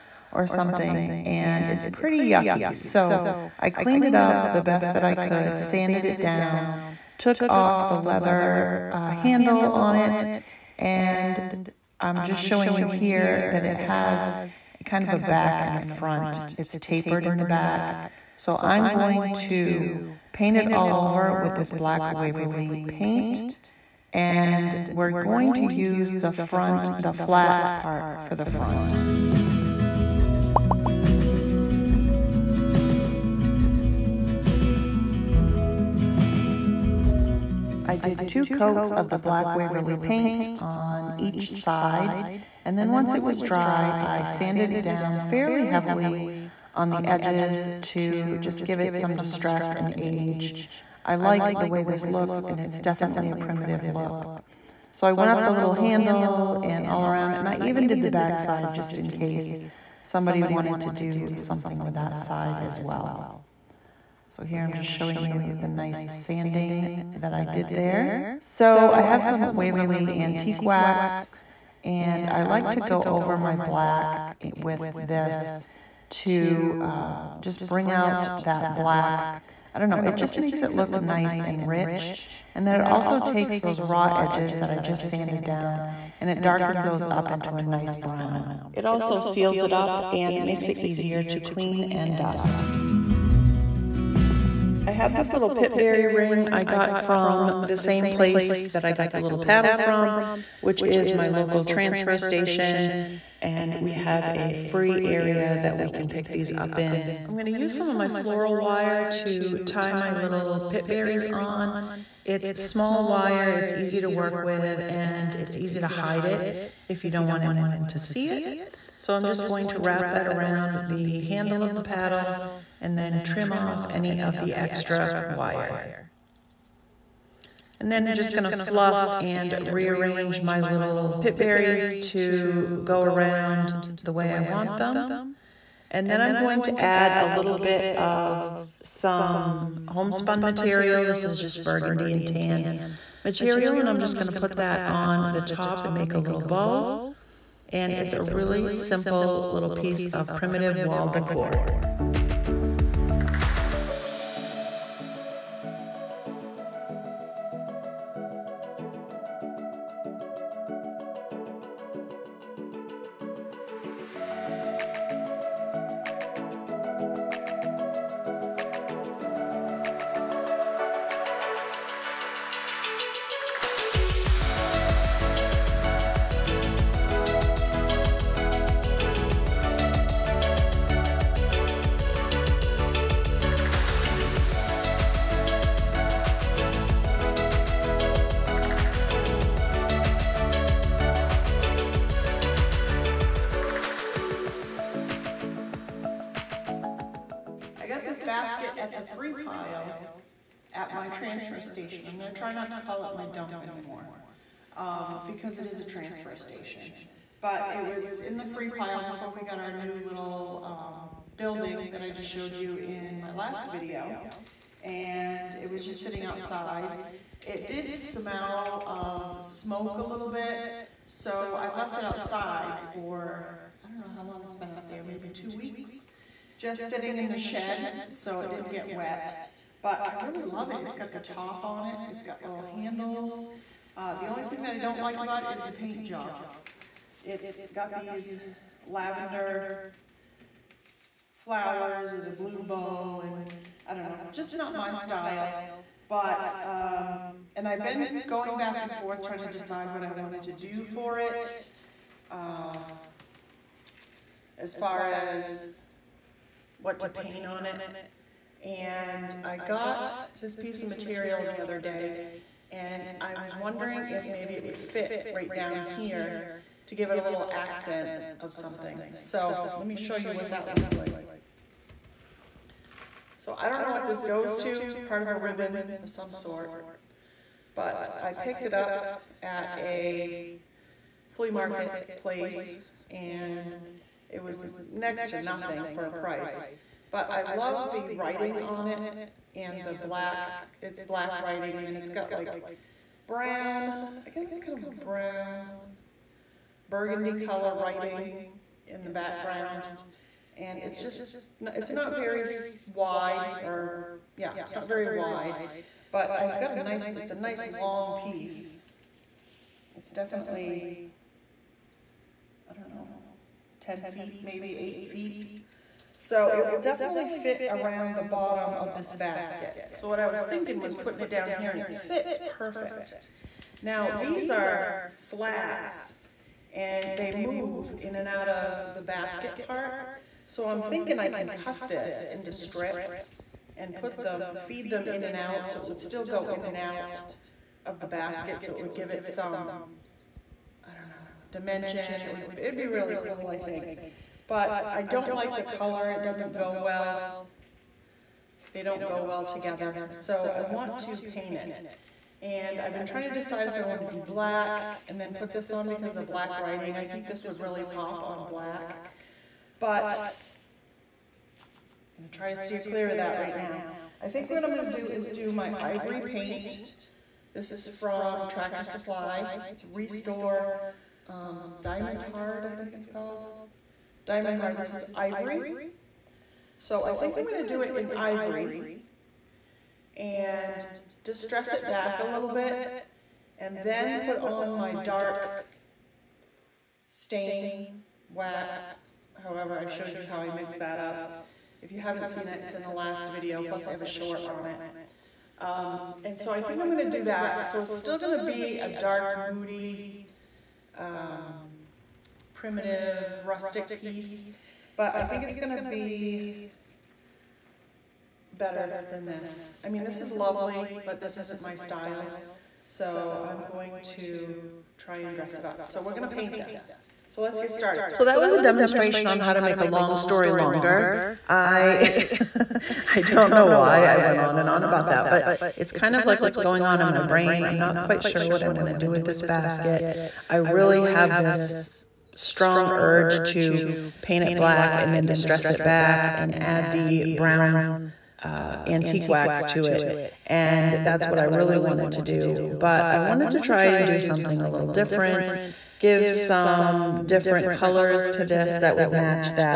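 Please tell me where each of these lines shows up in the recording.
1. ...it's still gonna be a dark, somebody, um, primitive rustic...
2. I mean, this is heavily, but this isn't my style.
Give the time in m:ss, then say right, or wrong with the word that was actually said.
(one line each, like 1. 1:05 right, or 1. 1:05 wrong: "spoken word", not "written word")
1. 6:37 wrong: "moody", not "somebody"
2. 6:49 wrong: "lovely", not "heavily".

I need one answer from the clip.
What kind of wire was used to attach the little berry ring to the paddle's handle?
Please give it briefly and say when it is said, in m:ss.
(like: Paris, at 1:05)
floral wire, at 1:48.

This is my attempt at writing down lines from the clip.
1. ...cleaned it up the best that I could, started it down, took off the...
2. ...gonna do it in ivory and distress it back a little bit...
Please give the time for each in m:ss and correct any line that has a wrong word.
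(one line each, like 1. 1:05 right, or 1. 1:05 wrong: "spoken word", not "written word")
1. 0:03 wrong: "sanded", not "started"
2. 6:17 right.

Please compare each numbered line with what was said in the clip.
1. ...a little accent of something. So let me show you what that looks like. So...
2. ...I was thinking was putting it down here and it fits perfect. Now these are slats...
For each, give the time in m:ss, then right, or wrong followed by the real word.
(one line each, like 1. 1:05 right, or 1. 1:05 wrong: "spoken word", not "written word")
1. 4:27 right
2. 5:20 right.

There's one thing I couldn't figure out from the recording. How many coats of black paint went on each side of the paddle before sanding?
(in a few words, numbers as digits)
2.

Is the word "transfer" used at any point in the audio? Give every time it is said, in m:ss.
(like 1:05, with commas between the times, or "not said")
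1:41, 3:21, 3:25.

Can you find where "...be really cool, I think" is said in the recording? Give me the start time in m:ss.
5:42.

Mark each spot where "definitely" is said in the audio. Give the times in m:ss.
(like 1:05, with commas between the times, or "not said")
0:52, 5:10, 5:16.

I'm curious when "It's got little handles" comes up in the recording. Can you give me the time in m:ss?
3:52.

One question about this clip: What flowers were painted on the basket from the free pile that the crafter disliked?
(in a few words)
lavender flowers.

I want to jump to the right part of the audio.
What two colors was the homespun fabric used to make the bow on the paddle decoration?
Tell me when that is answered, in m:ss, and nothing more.
2:21.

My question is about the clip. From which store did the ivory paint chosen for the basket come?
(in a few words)
Tractor Supply.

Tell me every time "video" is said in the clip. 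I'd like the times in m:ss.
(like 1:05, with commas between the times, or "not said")
3:33, 6:33.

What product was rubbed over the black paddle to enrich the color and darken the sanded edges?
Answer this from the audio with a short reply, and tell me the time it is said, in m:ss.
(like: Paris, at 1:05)
Waverly Antique Wax, at 1:09.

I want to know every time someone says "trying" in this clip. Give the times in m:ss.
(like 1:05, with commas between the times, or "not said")
4:09, 5:53.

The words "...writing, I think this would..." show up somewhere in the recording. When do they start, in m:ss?
5:56.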